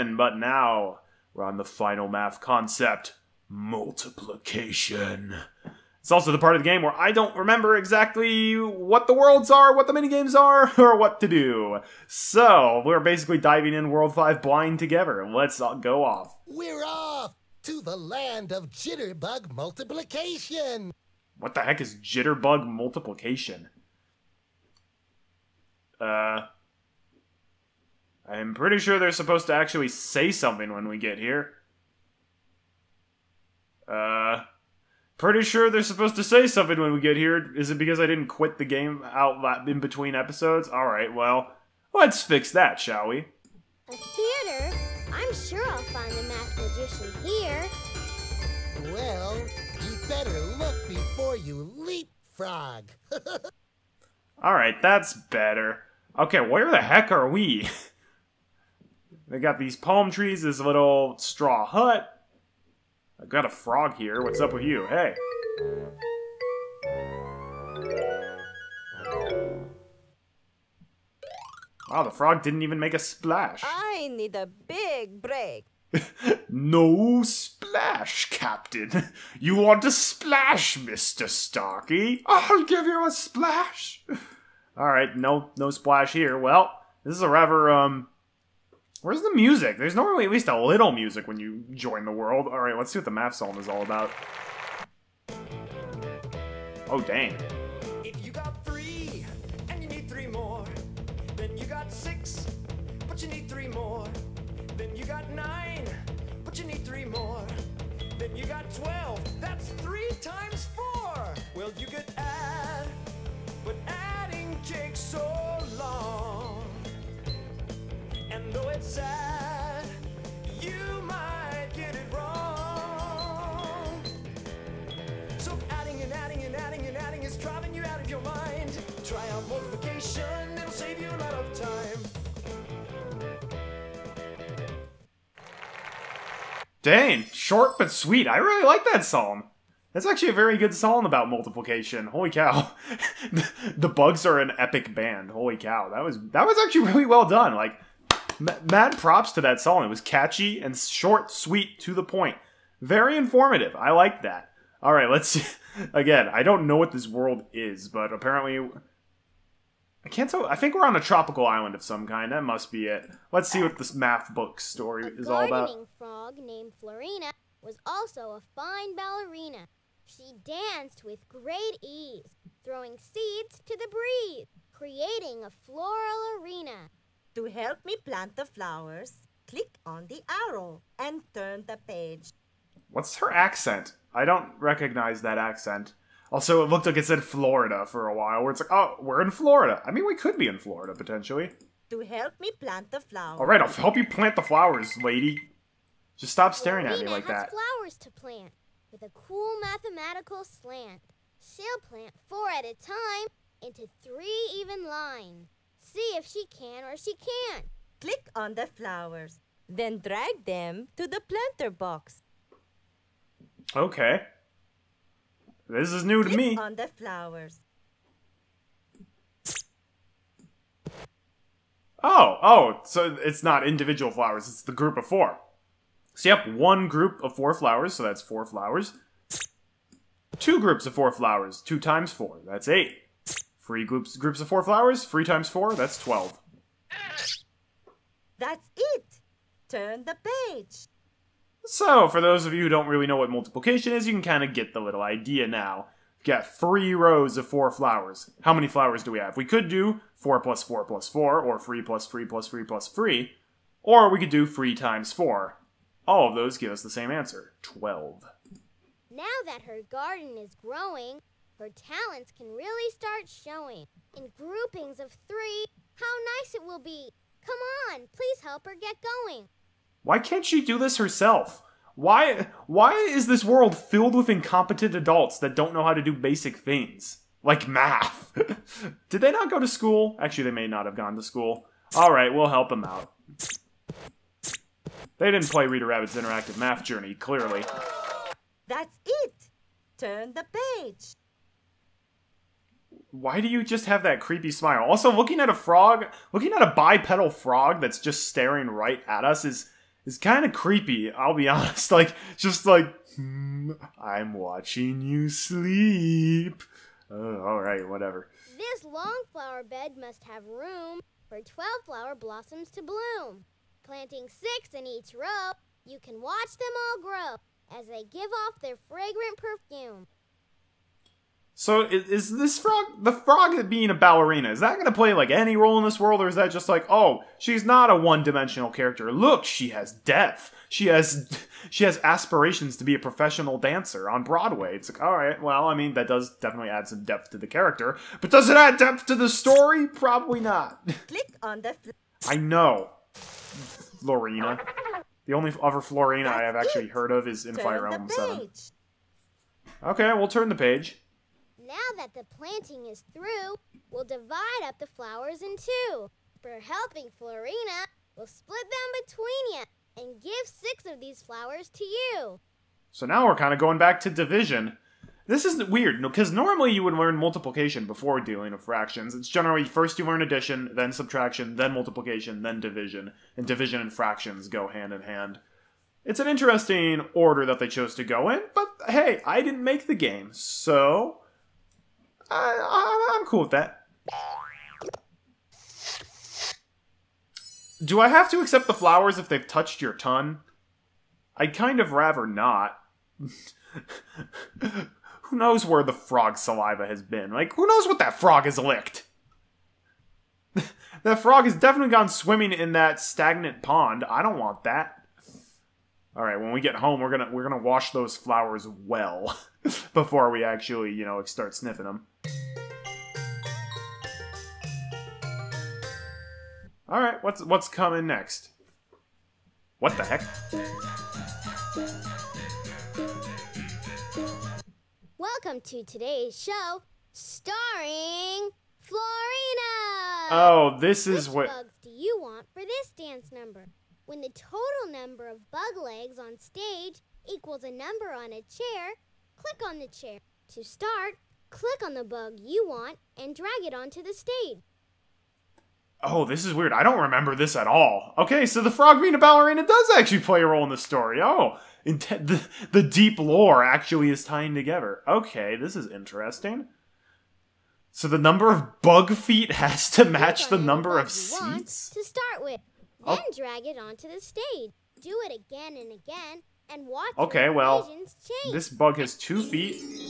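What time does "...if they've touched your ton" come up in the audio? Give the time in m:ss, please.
6:29.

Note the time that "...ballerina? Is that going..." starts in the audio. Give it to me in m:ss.
5:23.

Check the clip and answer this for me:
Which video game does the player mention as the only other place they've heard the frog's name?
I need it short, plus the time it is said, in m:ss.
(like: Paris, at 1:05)
Fire Emblem Seven, at 5:47.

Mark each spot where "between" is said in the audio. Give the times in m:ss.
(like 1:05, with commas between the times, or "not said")
0:39, 5:59.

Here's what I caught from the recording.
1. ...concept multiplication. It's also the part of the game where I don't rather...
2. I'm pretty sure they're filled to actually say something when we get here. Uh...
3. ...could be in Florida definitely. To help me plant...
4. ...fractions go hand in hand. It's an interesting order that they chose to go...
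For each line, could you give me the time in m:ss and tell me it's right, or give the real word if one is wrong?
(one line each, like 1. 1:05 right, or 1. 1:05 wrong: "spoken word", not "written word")
1. 0:02 wrong: "remember", not "rather"
2. 0:28 wrong: "supposed", not "filled"
3. 3:10 wrong: "potentially", not "definitely"
4. 6:13 right.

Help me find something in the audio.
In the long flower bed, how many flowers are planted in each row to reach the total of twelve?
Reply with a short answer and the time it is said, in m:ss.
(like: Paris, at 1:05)
6, at 5:14.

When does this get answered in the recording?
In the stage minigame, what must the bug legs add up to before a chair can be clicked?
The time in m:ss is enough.
7:17.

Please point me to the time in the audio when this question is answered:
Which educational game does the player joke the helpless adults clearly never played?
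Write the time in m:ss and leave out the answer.
4:45.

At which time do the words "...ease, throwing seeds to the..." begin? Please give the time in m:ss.
2:51.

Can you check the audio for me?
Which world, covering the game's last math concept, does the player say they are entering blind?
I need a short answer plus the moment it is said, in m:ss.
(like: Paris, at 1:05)
World 5, at 0:13.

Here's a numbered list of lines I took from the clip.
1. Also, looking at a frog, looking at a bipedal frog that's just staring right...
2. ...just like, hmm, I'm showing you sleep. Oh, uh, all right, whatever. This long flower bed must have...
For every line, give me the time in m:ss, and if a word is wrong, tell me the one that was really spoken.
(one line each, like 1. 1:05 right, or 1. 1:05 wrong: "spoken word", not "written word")
1. 4:54 right
2. 5:02 wrong: "watching", not "showing".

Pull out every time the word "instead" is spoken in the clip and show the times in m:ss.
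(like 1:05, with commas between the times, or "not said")
not said.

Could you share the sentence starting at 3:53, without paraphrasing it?
Free groups groups of four flowers.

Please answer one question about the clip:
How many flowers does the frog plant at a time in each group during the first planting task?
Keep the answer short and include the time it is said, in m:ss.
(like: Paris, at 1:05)
4, at 3:22.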